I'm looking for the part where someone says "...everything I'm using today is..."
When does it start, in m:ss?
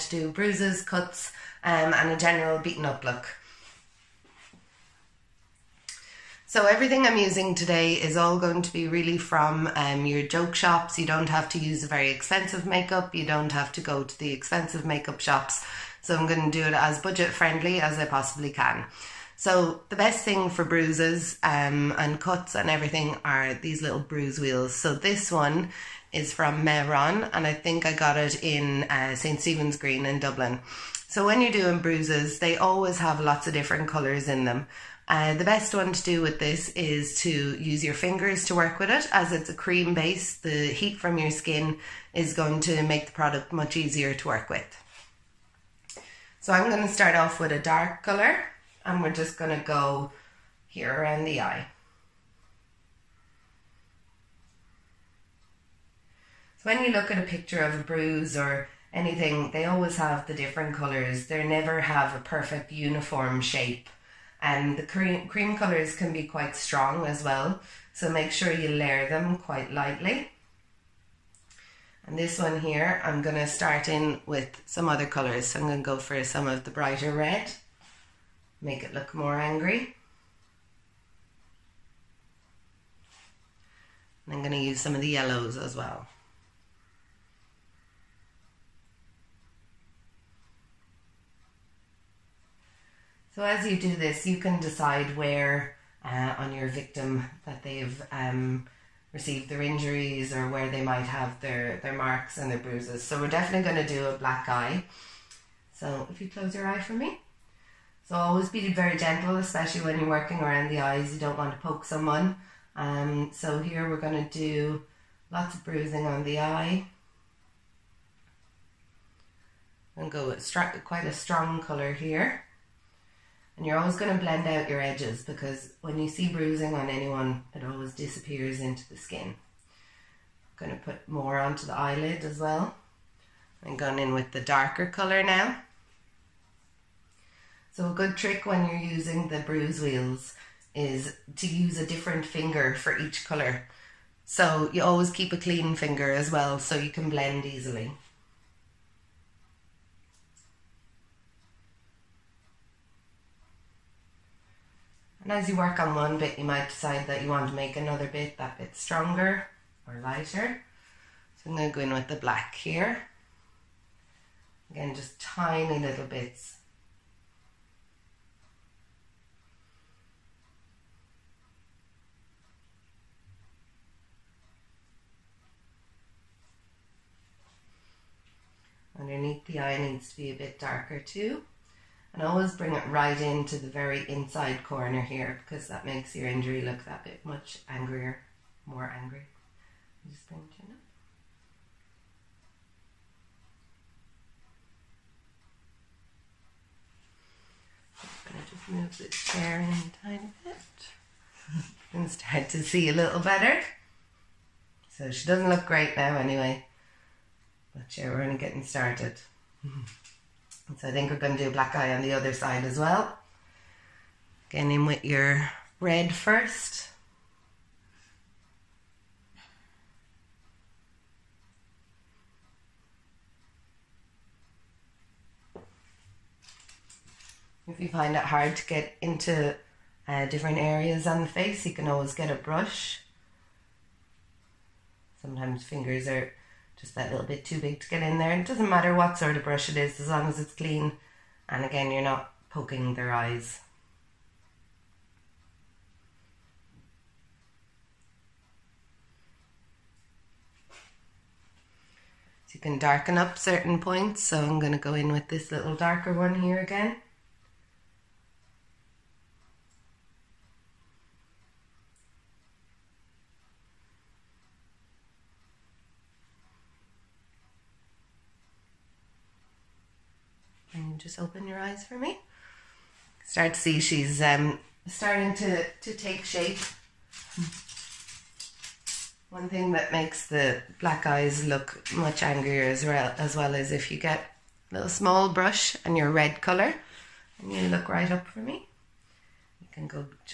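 0:06.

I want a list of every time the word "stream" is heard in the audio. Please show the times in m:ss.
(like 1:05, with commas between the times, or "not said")
not said.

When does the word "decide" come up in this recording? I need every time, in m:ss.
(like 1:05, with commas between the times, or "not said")
1:34, 2:36.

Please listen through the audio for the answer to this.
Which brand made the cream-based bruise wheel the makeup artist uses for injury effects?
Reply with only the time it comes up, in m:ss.
0:26.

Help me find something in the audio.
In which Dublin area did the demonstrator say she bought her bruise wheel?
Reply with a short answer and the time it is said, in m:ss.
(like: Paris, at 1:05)
St. Stephen's Green, at 0:29.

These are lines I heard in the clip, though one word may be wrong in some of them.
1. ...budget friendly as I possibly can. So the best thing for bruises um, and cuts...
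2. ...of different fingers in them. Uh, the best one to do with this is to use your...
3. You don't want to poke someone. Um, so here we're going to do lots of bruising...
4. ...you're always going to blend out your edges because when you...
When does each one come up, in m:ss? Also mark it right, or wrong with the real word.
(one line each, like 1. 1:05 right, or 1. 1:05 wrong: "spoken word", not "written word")
1. 0:17 right
2. 0:33 wrong: "colours", not "fingers"
3. 1:51 right
4. 2:03 right.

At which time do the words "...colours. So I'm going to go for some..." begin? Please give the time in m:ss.
1:15.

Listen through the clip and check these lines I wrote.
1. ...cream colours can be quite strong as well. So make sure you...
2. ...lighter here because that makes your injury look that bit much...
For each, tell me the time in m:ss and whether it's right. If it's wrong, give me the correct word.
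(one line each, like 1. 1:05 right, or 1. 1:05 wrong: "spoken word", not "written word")
1. 1:05 right
2. 3:04 wrong: "corner", not "lighter".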